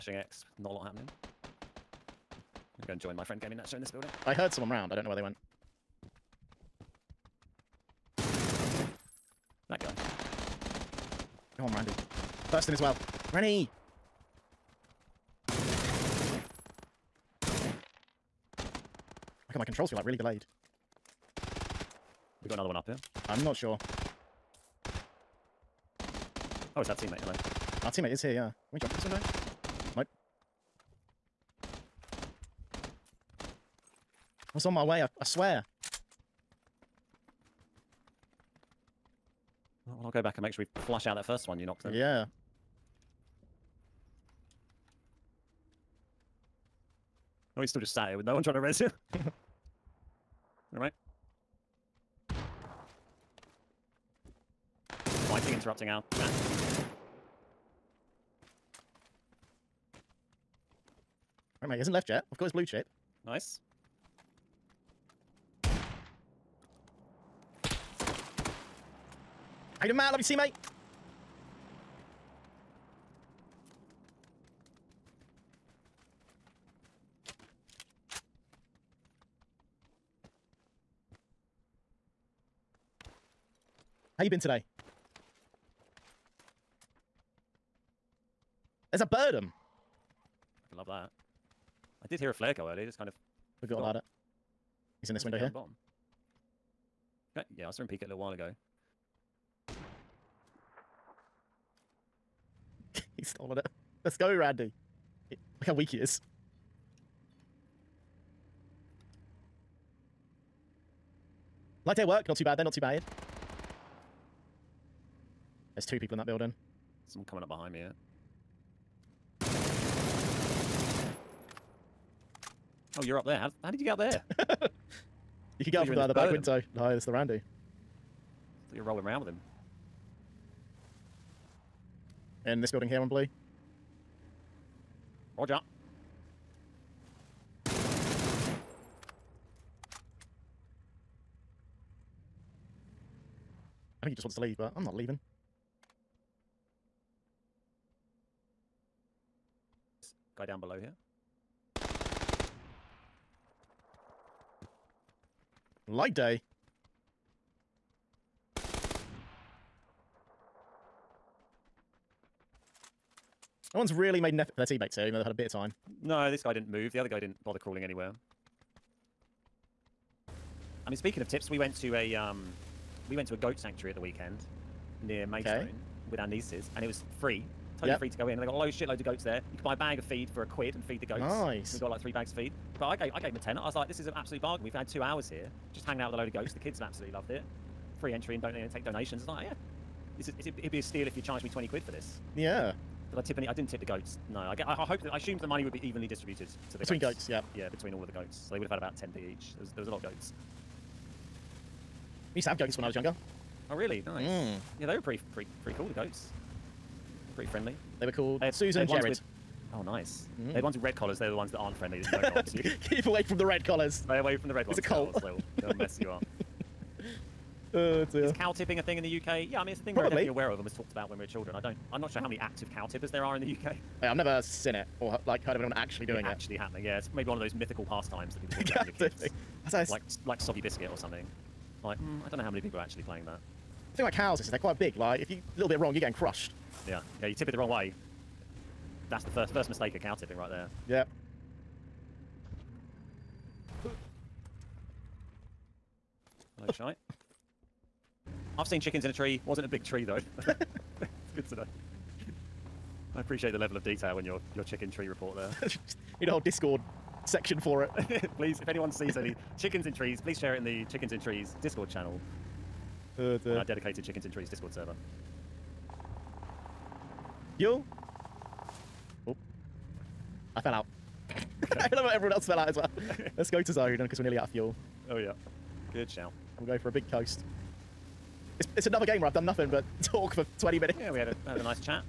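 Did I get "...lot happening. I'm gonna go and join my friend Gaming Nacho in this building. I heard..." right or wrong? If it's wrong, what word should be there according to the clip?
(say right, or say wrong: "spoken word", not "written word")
right.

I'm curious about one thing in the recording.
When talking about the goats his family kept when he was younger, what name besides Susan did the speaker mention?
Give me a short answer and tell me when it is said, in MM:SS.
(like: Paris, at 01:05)
Jared, at 03:29.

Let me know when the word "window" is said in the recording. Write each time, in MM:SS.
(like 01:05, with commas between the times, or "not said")
00:29, 01:35, 02:06.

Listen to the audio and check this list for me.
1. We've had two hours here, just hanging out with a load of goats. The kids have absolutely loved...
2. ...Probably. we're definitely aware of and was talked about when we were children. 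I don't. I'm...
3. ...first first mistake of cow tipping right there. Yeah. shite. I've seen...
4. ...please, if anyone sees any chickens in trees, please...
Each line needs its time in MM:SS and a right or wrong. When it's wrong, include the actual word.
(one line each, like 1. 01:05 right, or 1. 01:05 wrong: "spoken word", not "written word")
1. 03:04 right
2. 03:39 right
3. 03:59 right
4. 04:18 right.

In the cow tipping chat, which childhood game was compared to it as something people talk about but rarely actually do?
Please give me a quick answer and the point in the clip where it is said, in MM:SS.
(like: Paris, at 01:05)
soggy biscuit, at 03:50.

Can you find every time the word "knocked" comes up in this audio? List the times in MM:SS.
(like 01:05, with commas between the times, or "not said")
00:41.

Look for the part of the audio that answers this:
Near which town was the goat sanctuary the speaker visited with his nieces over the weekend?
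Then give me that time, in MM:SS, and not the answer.
02:55.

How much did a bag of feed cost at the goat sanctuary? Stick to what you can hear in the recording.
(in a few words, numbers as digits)
a quid.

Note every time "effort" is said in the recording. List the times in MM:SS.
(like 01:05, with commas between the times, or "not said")
02:44.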